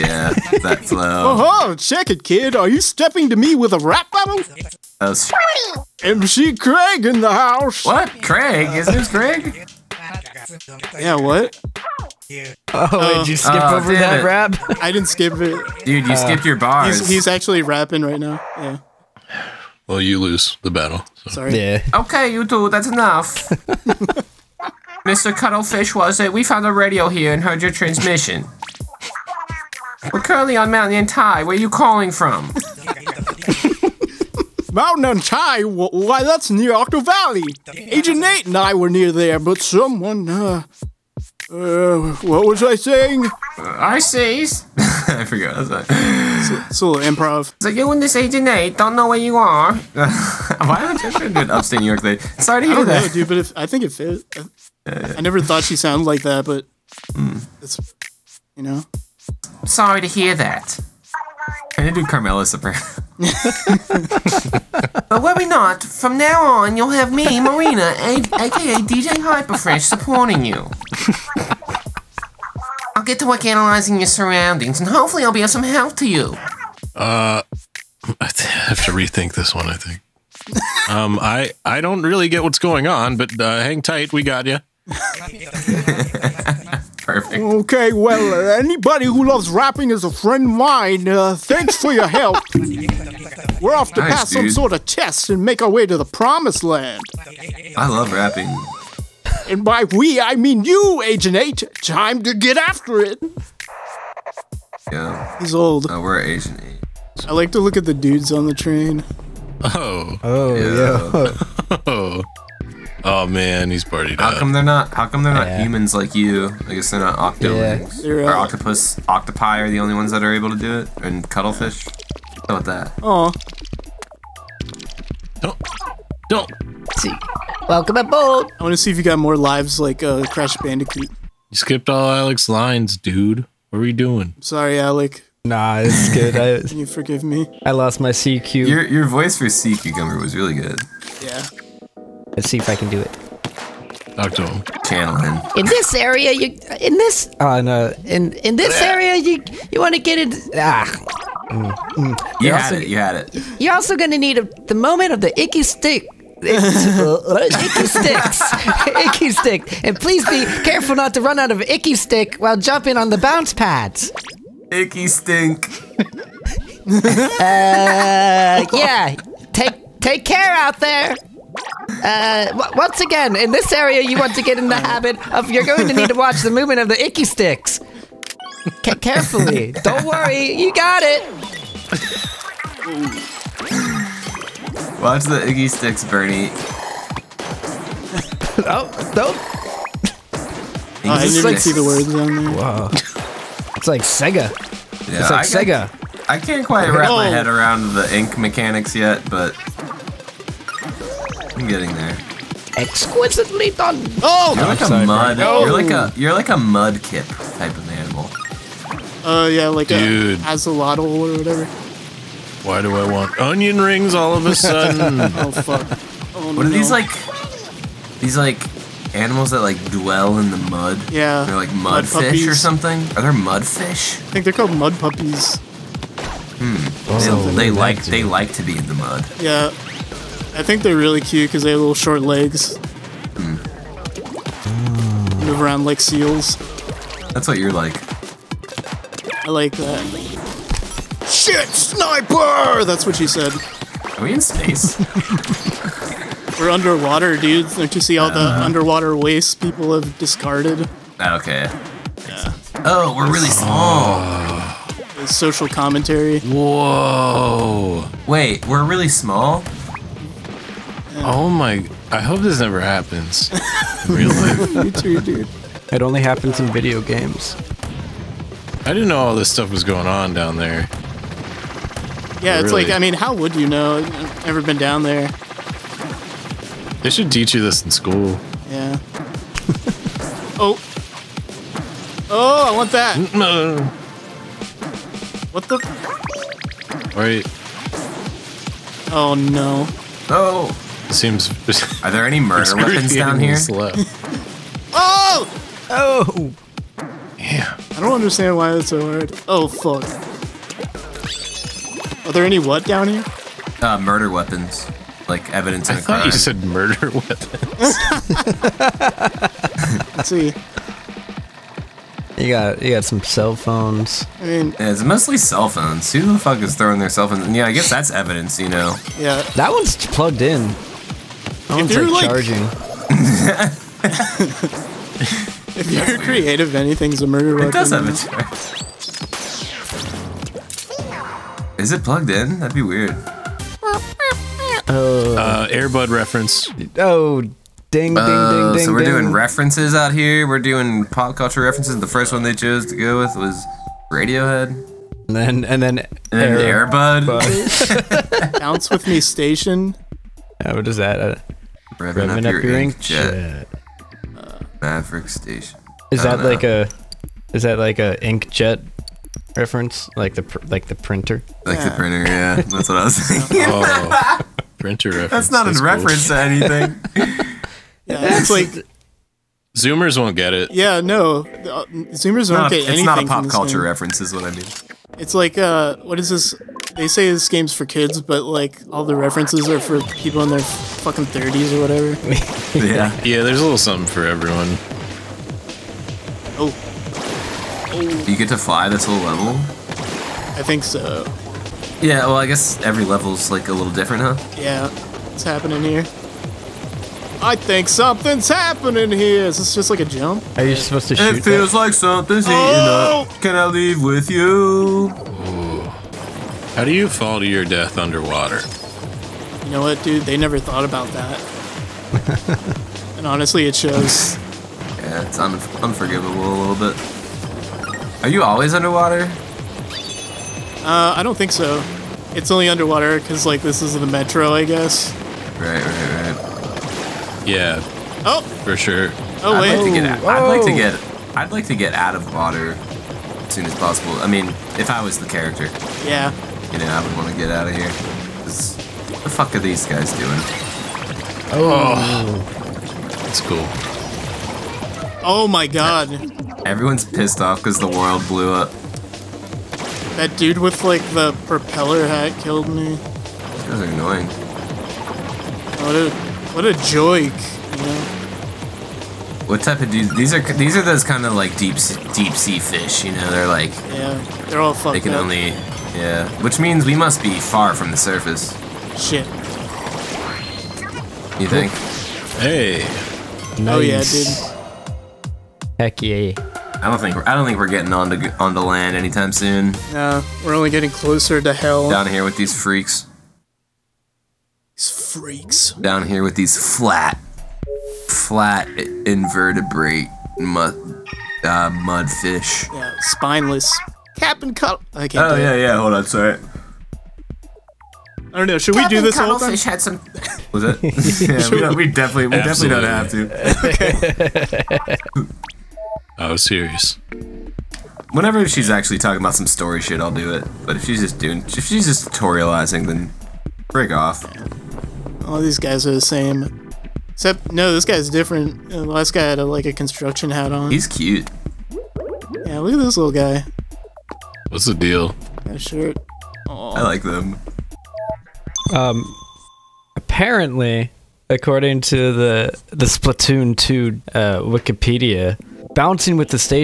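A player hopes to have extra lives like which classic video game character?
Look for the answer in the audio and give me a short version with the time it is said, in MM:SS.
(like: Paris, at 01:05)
Crash Bandicoot, at 02:10.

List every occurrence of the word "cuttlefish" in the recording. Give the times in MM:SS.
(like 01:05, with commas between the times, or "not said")
00:25, 02:01.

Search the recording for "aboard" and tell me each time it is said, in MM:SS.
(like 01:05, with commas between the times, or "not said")
02:07.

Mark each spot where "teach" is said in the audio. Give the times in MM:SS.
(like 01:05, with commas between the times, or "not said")
04:37.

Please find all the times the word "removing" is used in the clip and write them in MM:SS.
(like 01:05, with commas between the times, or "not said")
not said.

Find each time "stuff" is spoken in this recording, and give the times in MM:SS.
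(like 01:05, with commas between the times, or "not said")
04:29.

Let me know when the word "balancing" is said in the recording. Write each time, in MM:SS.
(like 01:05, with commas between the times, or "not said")
not said.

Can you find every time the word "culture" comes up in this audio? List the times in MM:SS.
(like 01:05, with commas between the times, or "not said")
05:41, 06:13.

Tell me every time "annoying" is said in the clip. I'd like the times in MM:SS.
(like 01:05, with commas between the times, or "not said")
07:33.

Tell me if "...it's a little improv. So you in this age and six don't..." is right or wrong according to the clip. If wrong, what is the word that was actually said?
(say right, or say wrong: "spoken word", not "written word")
wrong: "eight", not "six".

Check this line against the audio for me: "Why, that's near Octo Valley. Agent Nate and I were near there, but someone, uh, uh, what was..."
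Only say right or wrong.
right.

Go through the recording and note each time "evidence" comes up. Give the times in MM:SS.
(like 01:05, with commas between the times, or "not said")
05:05, 05:18.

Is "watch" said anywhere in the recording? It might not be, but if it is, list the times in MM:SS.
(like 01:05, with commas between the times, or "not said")
02:56, 03:04.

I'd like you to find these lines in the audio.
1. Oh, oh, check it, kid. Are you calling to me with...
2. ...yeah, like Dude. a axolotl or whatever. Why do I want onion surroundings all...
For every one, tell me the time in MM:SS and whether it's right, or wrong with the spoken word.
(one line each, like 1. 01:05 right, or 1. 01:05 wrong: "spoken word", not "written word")
1. 00:01 wrong: "stepping", not "calling"
2. 03:29 wrong: "rings", not "surroundings".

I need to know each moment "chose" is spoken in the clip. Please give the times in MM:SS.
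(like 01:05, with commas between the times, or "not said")
05:42.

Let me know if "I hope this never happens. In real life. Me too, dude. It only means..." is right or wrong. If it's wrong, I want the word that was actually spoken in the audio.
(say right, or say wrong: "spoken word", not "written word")
wrong: "happens", not "means".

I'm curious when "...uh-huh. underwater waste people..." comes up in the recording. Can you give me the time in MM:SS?
04:08.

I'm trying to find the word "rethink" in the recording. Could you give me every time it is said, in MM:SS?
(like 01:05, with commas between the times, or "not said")
01:18.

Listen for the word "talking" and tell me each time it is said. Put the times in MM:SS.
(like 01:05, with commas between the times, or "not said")
08:28.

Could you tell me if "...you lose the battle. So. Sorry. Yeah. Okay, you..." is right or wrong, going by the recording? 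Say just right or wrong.
right.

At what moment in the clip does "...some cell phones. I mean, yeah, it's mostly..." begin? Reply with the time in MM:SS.
05:13.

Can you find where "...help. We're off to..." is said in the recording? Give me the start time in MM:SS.
01:32.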